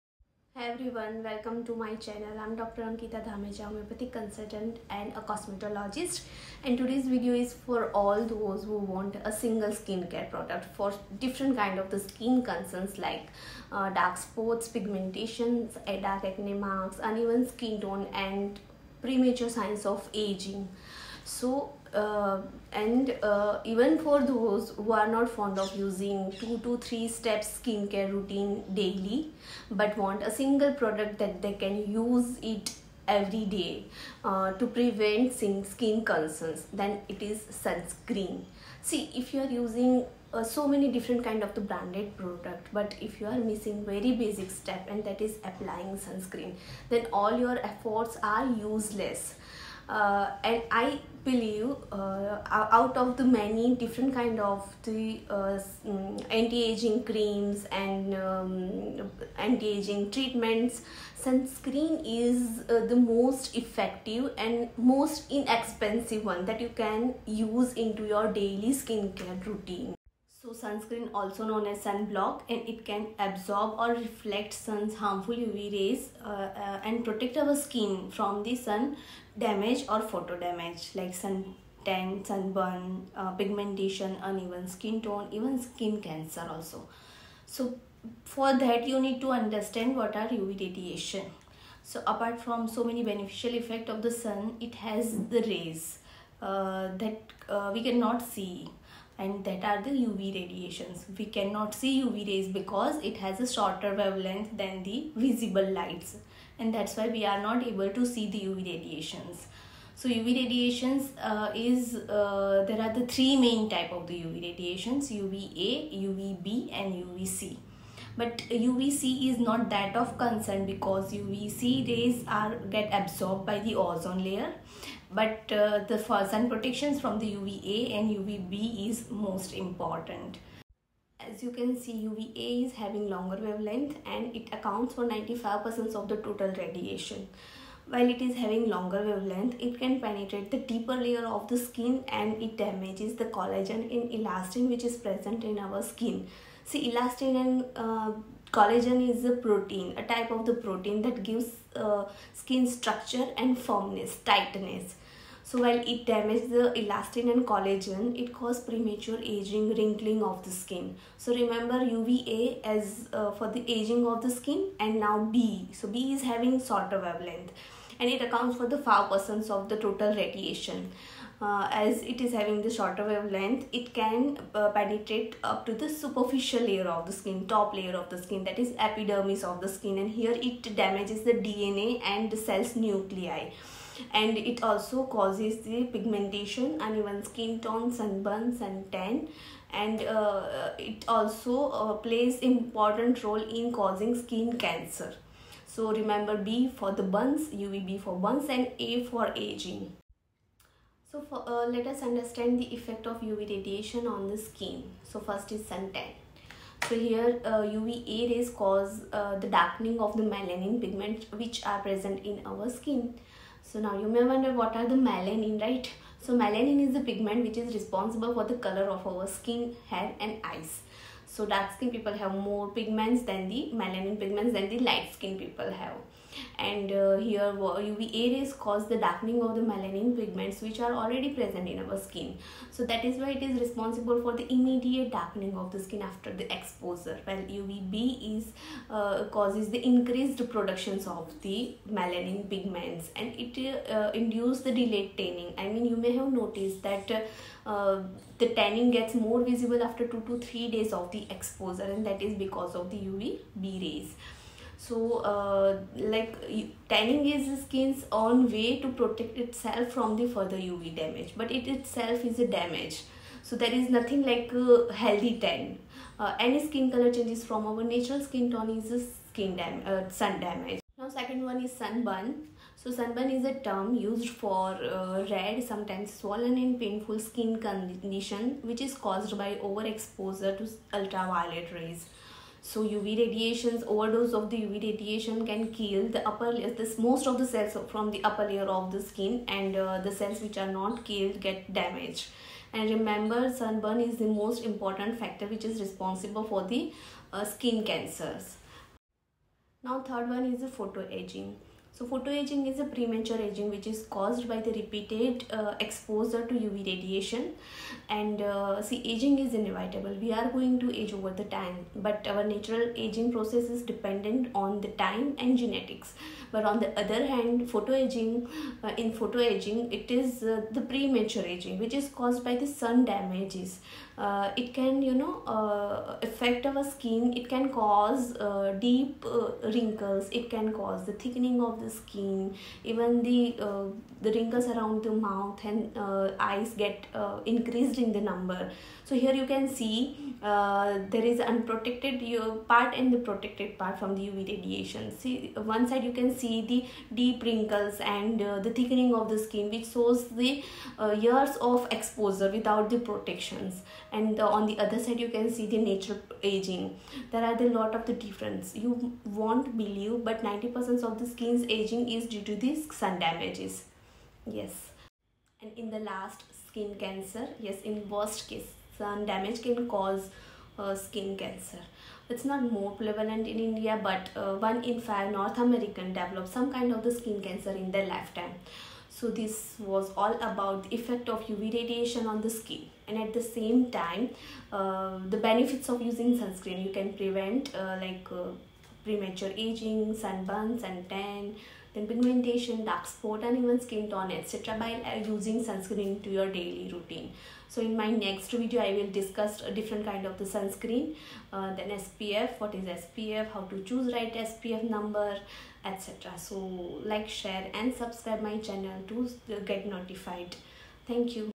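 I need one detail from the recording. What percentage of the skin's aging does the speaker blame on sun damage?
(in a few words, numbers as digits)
90%.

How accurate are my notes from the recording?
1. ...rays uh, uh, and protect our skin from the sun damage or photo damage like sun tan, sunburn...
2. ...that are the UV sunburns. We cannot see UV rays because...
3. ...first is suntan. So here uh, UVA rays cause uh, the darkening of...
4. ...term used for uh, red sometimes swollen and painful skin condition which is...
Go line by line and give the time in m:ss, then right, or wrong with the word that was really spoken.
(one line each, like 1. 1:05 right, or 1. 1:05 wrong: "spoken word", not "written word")
1. 1:15 right
2. 1:39 wrong: "radiations", not "sunburns"
3. 3:25 right
4. 4:33 right.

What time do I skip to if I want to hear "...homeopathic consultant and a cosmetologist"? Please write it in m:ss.
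0:03.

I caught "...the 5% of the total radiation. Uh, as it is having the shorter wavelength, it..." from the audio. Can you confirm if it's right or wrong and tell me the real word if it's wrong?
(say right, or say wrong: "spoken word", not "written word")
right.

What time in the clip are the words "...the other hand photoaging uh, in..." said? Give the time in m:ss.
5:16.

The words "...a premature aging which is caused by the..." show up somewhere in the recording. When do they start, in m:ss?
5:02.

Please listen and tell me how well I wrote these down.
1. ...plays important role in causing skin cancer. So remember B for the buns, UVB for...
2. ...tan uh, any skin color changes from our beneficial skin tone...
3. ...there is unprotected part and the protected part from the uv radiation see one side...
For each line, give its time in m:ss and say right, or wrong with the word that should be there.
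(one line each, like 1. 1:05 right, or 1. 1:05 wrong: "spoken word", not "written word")
1. 3:11 right
2. 4:25 wrong: "natural", not "beneficial"
3. 5:41 right.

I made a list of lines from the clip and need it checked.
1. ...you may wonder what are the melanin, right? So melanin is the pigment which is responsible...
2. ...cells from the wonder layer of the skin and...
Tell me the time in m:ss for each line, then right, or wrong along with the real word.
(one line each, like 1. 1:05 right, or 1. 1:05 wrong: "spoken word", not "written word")
1. 3:33 right
2. 4:47 wrong: "upper", not "wonder".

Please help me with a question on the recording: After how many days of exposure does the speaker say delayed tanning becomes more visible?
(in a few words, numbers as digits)
2 to 3 days.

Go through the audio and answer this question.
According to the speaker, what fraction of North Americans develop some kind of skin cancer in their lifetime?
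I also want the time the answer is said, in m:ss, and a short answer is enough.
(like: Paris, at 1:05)
one in five, at 6:14.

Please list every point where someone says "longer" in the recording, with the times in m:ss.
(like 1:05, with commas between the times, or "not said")
2:13, 2:18.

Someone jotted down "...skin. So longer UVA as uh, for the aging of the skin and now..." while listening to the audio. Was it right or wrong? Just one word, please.
wrong.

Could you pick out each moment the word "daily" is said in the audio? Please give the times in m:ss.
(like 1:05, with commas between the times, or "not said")
0:28, 1:08, 6:36.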